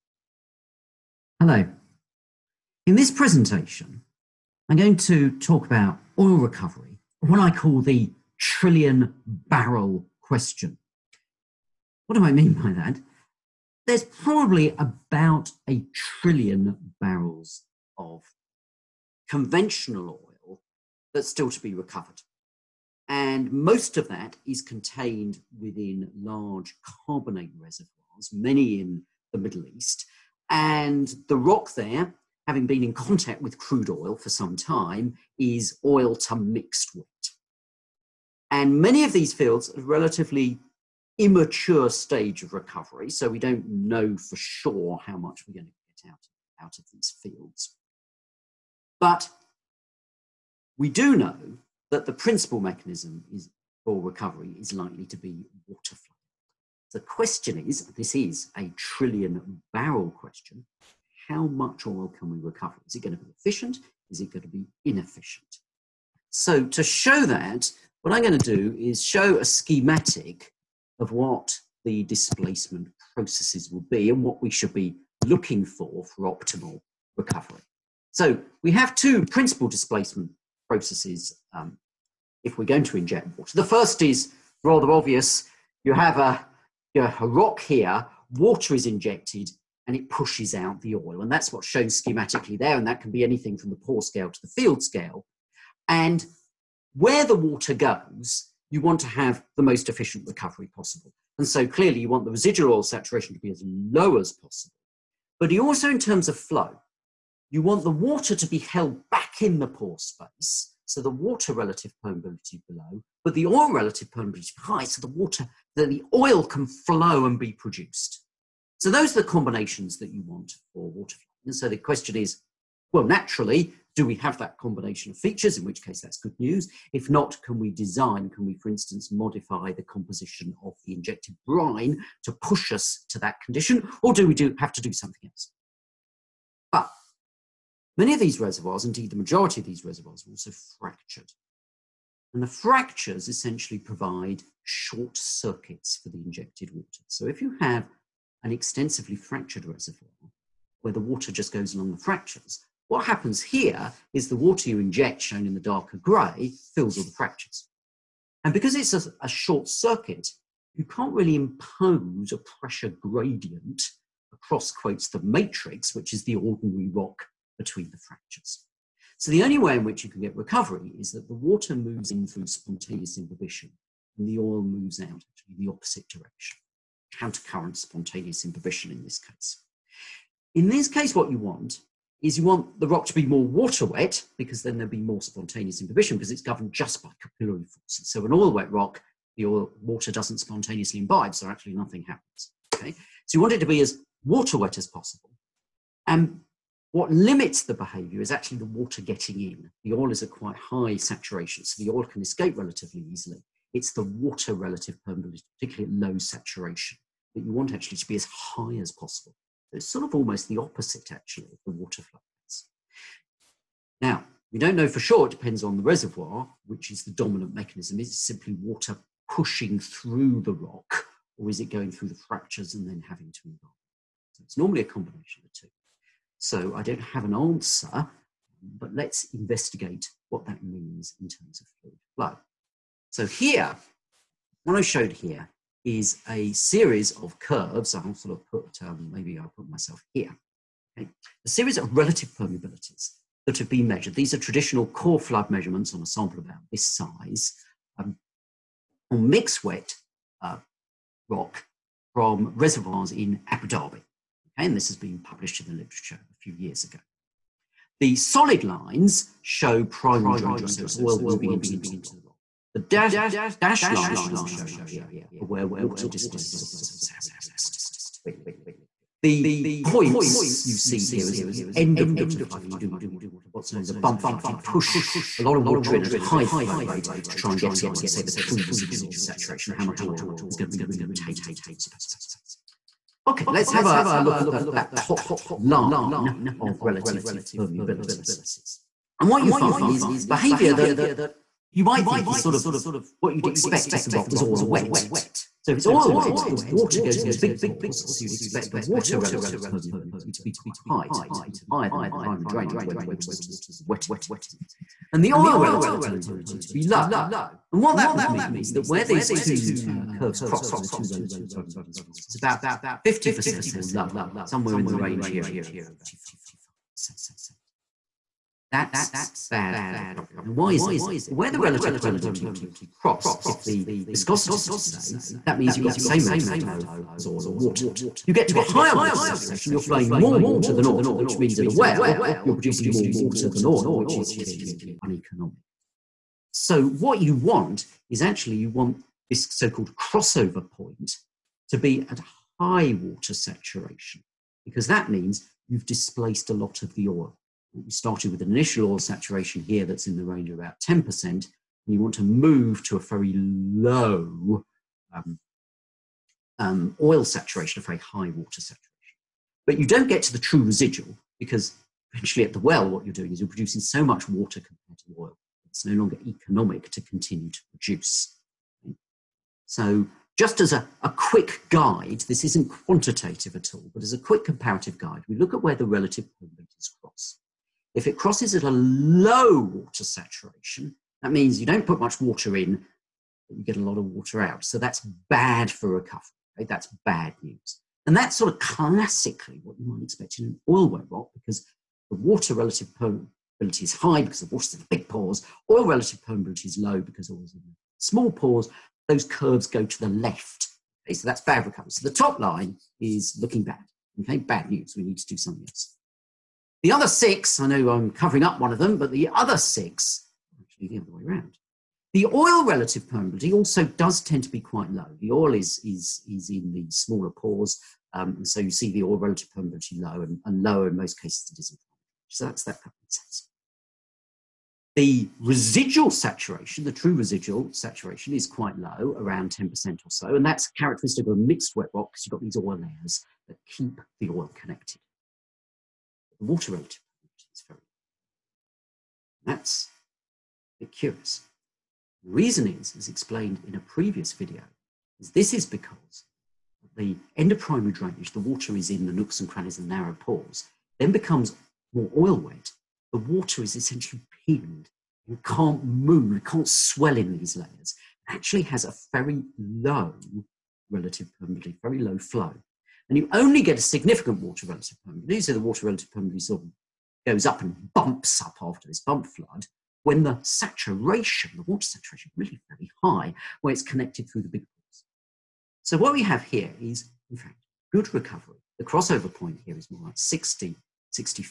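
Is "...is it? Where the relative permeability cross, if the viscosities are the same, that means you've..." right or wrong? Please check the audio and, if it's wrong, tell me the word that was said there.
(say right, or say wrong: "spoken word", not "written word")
right.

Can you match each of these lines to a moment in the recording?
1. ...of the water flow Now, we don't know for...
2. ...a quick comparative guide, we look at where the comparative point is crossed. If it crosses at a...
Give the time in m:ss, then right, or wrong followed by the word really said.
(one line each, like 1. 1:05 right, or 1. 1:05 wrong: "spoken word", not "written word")
1. 3:31 right
2. 6:14 wrong: "relative", not "comparative".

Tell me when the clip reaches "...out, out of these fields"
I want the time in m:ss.
0:46.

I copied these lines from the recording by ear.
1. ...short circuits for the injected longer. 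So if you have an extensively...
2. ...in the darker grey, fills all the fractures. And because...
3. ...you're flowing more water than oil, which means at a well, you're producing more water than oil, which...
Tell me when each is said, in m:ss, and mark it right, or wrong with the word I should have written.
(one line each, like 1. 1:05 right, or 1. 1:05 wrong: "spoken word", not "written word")
1. 2:24 wrong: "water", not "longer"
2. 2:35 right
3. 5:29 right.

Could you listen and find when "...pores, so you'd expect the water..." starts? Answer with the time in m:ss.
4:57.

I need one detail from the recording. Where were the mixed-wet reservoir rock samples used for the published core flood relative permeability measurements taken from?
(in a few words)
Abu Dhabi.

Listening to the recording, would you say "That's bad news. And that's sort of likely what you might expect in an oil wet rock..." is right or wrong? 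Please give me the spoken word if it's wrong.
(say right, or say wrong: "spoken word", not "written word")
wrong: "classically", not "likely".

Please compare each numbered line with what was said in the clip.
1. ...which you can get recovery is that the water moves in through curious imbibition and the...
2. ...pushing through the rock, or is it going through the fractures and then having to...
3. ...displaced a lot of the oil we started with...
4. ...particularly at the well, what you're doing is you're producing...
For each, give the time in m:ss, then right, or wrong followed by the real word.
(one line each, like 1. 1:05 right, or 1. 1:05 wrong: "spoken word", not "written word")
1. 2:49 wrong: "spontaneous", not "curious"
2. 3:39 right
3. 5:45 right
4. 6:02 wrong: "eventually", not "particularly".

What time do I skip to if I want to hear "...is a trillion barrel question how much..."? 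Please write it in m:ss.
0:58.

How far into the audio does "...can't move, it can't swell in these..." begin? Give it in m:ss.
7:35.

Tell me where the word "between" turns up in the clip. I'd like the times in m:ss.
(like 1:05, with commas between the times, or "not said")
2:47.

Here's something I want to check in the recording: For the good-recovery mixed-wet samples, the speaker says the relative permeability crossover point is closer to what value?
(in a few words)
60.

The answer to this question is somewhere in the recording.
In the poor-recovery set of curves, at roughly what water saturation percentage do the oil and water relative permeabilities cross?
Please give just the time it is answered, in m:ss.
5:15.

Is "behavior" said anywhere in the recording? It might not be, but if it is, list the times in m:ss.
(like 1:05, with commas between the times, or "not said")
3:17, 4:50.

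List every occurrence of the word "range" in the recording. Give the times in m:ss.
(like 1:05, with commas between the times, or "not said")
5:14, 5:50.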